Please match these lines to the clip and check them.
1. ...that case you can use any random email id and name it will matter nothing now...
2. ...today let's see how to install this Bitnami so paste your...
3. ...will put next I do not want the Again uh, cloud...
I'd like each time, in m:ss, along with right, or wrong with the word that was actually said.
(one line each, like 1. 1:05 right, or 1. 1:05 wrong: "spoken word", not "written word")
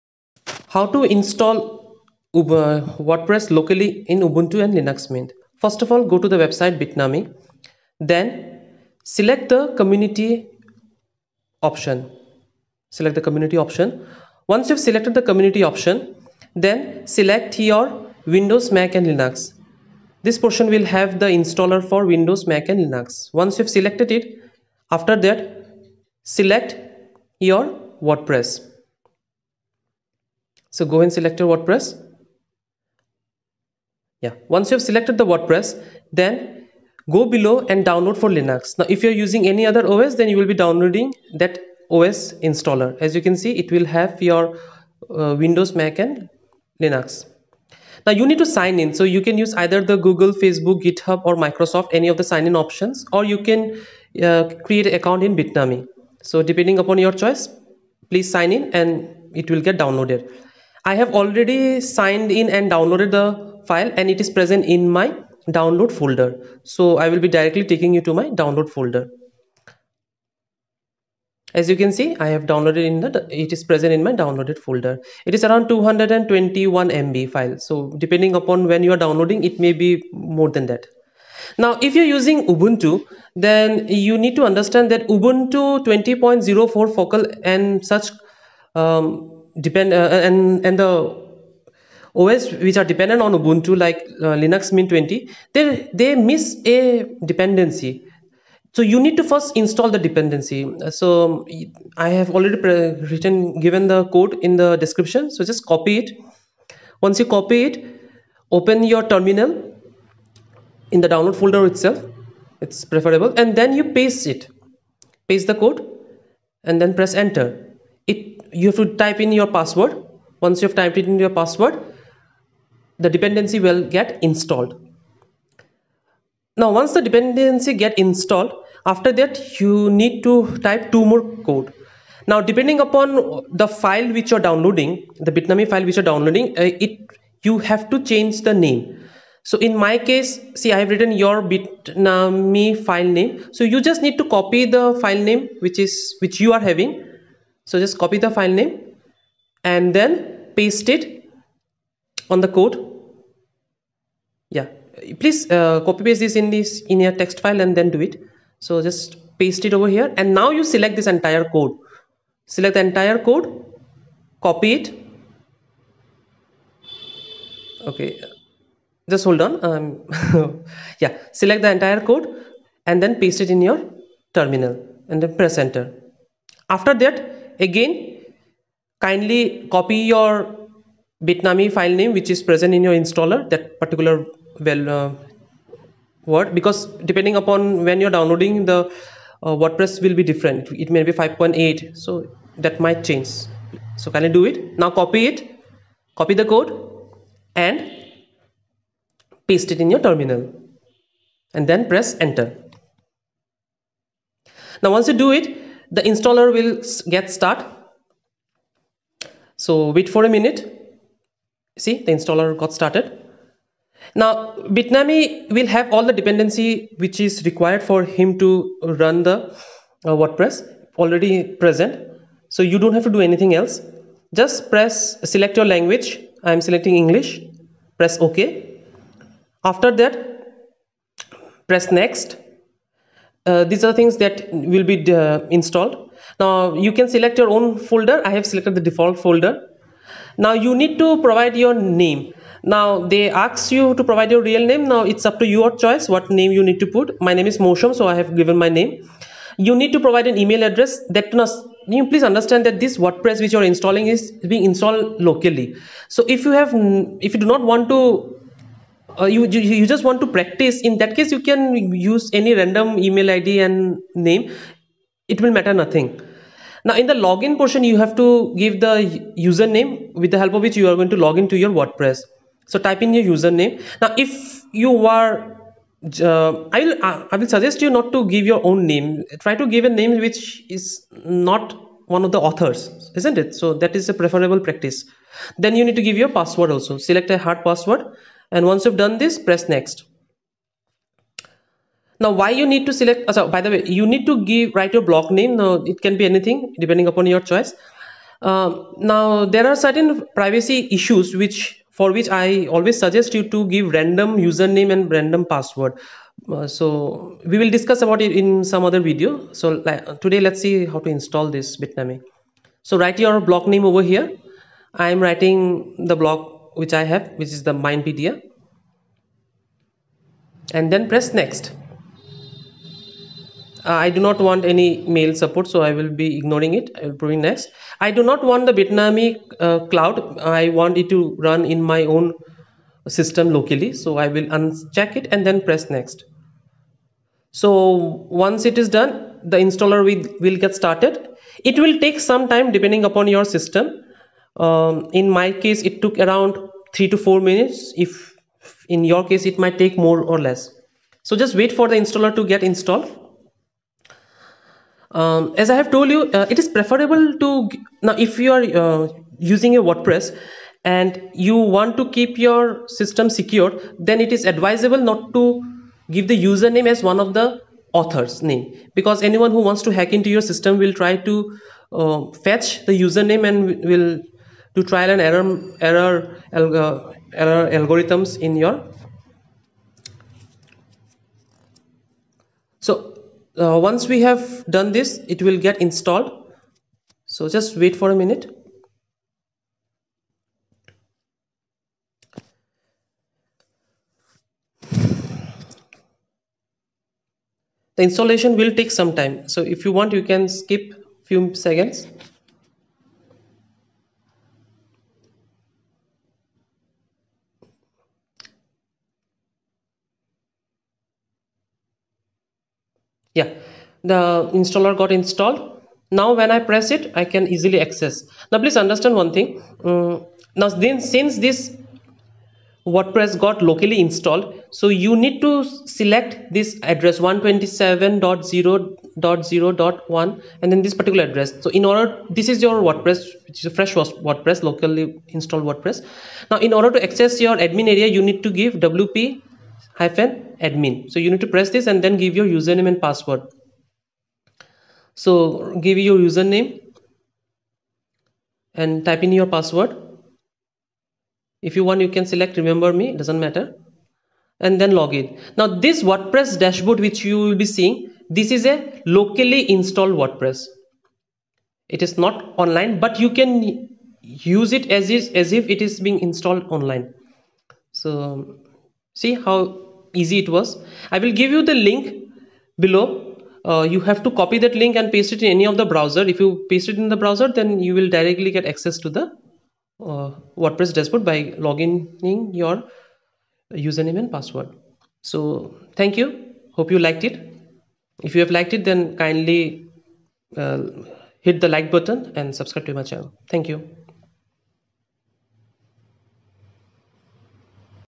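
1. 4:20 right
2. 5:10 wrong: "write", not "paste"
3. 5:27 wrong: "Bitnami", not "Again".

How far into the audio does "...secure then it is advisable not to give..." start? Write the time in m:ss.
6:03.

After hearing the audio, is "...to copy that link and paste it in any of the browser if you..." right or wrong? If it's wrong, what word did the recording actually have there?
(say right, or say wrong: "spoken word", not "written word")
right.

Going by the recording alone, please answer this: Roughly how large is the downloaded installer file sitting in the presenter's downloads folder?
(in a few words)
221 MB.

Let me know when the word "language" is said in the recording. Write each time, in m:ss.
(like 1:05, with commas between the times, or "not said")
3:45.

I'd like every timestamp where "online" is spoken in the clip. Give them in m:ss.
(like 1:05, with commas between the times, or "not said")
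7:42, 7:46.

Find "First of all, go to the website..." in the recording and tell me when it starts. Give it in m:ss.
0:05.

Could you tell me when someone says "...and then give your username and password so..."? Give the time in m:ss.
7:21.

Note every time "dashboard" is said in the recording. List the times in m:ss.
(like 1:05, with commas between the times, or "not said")
7:36, 8:00.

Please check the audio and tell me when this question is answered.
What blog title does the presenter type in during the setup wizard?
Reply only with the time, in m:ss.
5:17.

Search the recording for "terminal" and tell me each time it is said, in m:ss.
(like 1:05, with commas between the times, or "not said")
1:49, 2:54, 3:19.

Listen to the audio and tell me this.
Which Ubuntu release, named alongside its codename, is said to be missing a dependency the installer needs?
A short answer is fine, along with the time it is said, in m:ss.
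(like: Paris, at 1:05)
Ubuntu 20.04, at 1:25.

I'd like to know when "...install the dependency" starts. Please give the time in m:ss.
1:39.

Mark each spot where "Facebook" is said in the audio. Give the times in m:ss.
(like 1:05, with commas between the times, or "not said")
0:50.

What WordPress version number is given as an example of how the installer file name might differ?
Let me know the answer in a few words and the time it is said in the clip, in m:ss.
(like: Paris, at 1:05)
5.8, at 3:11.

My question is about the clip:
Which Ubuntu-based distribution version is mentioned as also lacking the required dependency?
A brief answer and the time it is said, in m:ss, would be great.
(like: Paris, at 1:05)
Linux Mint 20, at 1:34.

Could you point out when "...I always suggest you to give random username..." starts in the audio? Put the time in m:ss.
5:02.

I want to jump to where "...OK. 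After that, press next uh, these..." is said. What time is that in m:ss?
3:48.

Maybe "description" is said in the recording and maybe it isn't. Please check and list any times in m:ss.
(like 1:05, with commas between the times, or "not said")
1:44.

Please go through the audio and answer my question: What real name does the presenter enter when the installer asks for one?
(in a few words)
Mosham.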